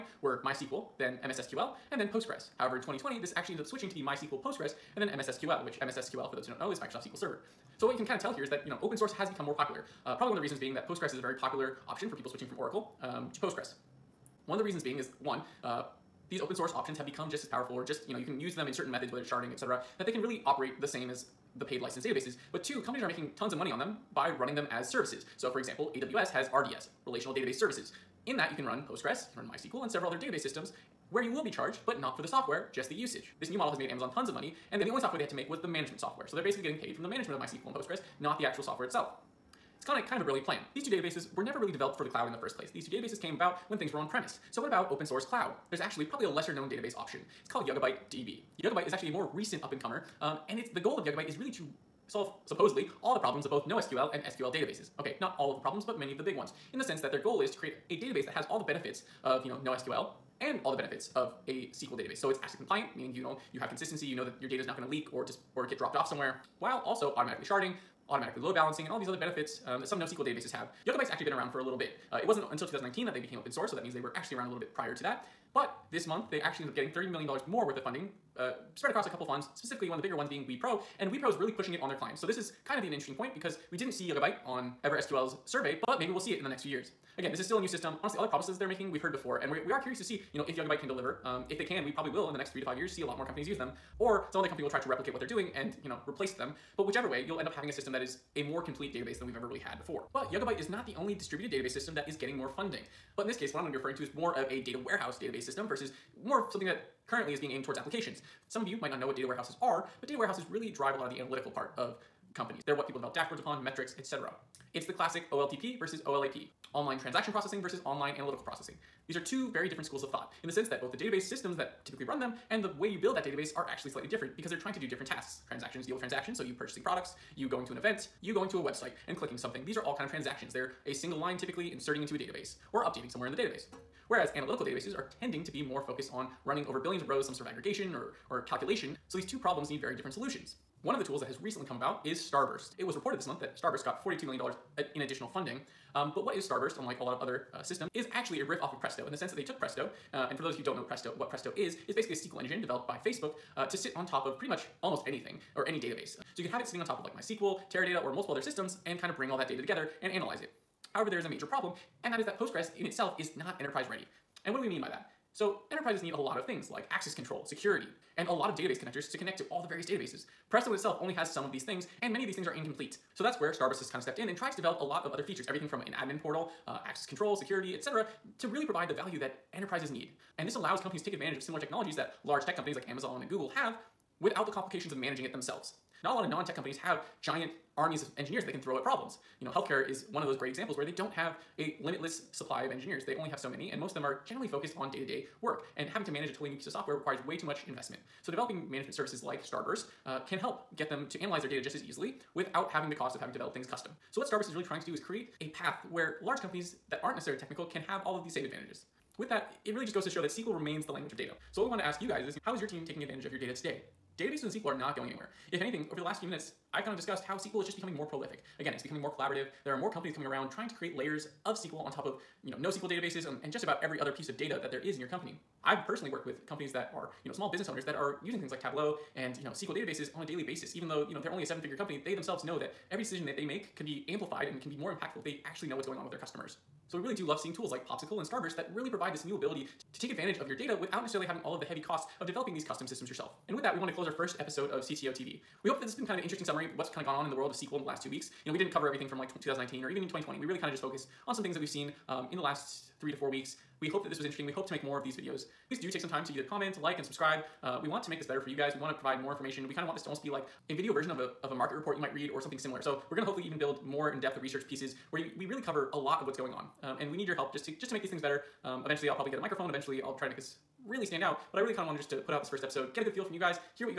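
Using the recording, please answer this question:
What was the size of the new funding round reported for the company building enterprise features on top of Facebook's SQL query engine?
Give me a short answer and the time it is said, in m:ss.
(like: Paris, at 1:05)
$42 million, at 2:24.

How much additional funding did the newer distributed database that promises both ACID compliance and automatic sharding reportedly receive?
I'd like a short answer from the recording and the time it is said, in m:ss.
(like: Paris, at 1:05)
$30 million, at 1:16.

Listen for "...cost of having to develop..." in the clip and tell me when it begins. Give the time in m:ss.
3:22.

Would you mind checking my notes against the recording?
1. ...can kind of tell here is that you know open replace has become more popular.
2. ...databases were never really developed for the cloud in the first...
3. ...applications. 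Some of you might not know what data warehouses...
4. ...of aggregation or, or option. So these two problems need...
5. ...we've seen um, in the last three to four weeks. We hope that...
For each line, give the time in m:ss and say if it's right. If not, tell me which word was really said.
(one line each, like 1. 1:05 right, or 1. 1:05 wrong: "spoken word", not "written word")
1. 0:07 wrong: "source", not "replace"
2. 0:40 right
3. 1:47 right
4. 2:17 wrong: "calculation", not "option"
5. 4:11 right.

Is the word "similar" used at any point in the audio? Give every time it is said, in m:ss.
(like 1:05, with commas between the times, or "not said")
3:01, 4:22.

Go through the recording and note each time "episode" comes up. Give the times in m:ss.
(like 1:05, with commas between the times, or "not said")
4:04, 4:32.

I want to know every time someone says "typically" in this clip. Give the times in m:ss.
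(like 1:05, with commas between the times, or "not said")
2:01, 2:11.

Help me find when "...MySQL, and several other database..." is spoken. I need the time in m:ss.
0:29.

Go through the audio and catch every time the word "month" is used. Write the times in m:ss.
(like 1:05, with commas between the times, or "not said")
1:16, 2:23.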